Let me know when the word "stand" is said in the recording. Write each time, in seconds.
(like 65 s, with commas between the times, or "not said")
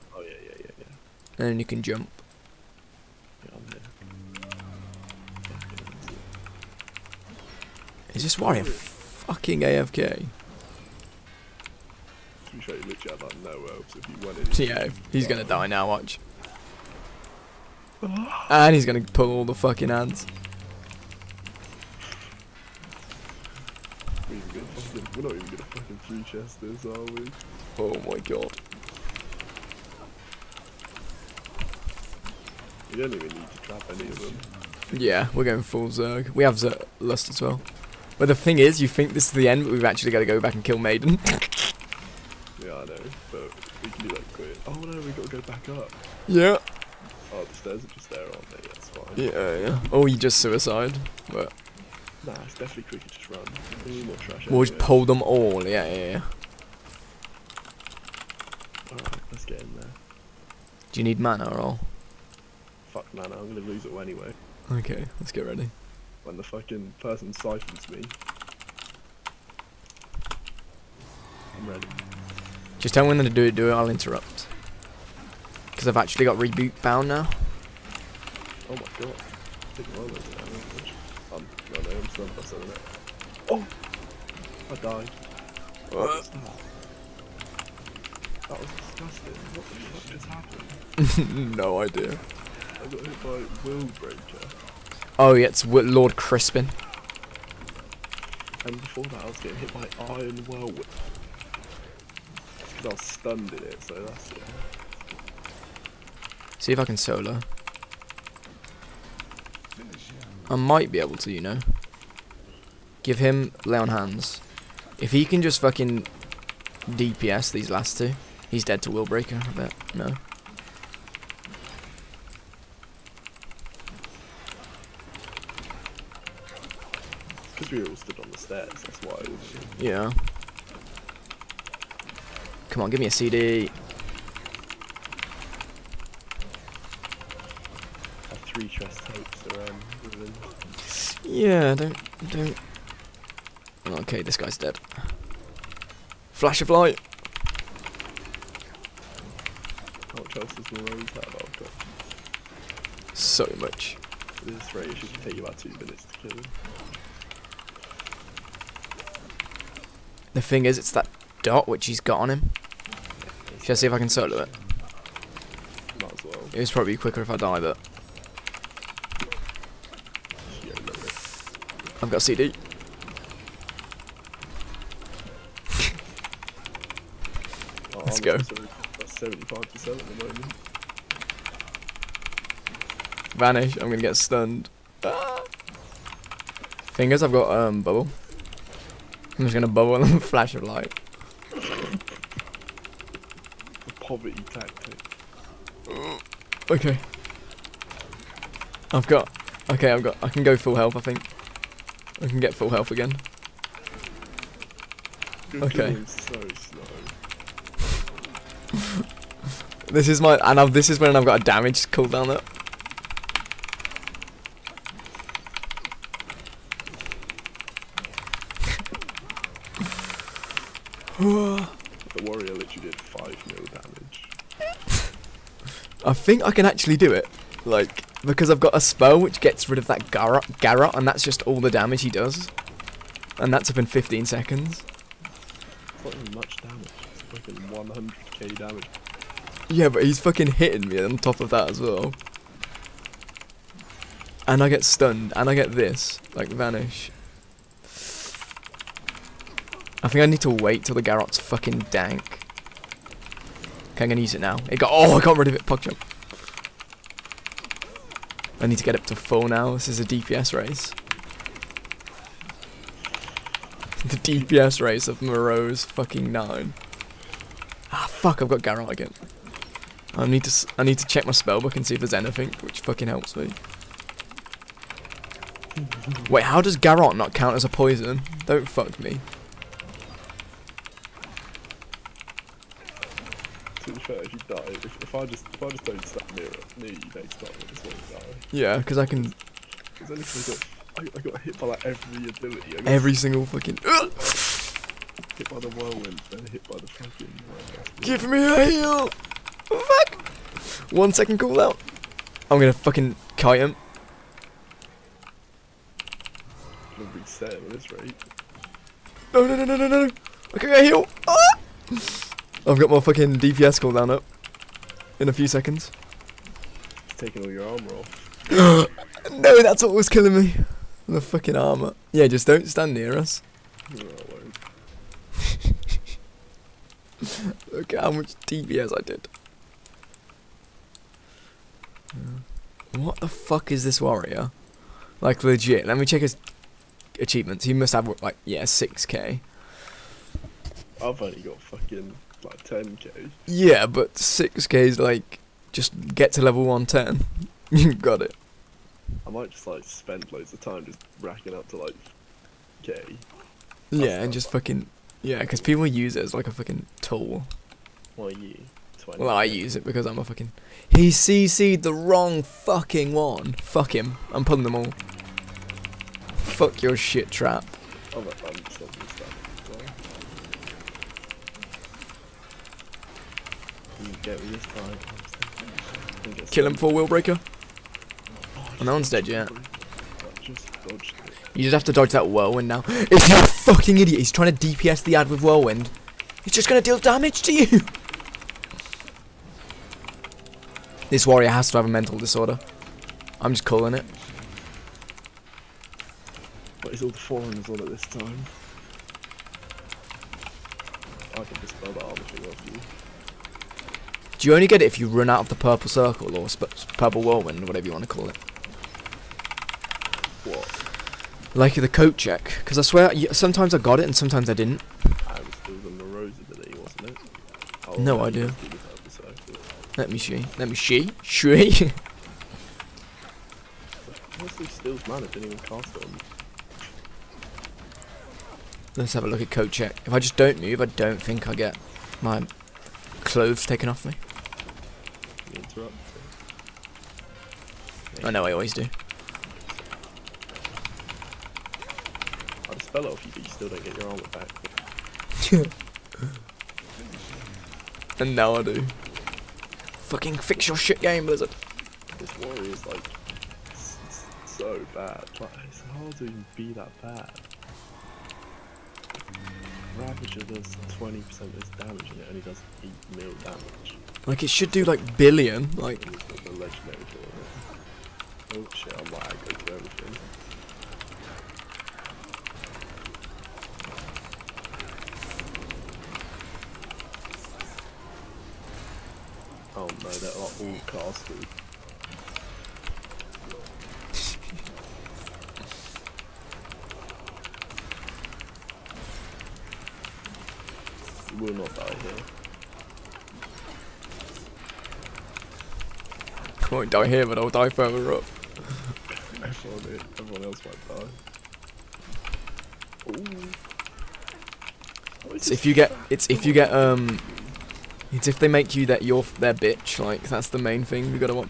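286 s, 322 s.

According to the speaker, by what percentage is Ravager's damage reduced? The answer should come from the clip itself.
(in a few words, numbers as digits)
20%.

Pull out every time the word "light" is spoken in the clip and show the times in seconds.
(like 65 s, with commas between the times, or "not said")
146 s, 190 s.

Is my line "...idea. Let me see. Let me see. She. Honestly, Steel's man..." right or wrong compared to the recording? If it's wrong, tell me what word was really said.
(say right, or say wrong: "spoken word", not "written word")
right.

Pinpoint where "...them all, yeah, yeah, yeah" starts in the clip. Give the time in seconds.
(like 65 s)
55 s.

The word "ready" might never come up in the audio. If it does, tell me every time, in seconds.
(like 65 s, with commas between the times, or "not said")
65 s, 71 s.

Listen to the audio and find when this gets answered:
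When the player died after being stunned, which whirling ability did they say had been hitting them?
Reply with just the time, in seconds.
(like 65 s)
100 s.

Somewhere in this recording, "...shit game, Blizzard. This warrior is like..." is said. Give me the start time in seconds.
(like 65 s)
450 s.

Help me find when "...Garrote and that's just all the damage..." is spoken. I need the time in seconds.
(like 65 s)
230 s.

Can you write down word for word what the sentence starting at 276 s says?
Wait, how does Garrote not count as a poison?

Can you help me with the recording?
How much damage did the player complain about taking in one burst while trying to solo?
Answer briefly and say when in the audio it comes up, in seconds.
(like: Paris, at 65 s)
100k, at 237 s.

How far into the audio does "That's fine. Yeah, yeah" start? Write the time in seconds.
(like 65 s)
48 s.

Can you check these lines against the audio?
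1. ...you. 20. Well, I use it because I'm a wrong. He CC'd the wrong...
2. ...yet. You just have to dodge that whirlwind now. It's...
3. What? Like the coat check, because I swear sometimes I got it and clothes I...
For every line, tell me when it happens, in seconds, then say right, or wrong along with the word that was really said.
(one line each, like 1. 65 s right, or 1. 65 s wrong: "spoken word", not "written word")
1. 358 s wrong: "fucking", not "wrong"
2. 379 s right
3. 410 s wrong: "sometimes", not "clothes".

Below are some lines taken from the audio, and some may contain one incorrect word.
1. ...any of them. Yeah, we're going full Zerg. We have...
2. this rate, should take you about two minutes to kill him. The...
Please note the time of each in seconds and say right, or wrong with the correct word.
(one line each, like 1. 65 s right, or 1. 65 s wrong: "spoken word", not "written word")
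1. 33 s right
2. 154 s right.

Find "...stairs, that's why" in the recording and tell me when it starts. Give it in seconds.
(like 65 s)
128 s.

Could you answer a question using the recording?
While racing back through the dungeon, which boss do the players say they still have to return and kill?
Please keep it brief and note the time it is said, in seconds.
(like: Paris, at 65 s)
Maiden, at 40 s.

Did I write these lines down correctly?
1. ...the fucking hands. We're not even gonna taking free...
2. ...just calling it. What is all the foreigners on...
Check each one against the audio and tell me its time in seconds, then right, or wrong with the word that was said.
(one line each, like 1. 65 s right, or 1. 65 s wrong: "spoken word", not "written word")
1. 19 s wrong: "fucking", not "taking"
2. 393 s right.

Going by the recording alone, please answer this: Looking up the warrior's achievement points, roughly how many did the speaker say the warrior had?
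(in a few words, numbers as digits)
6k.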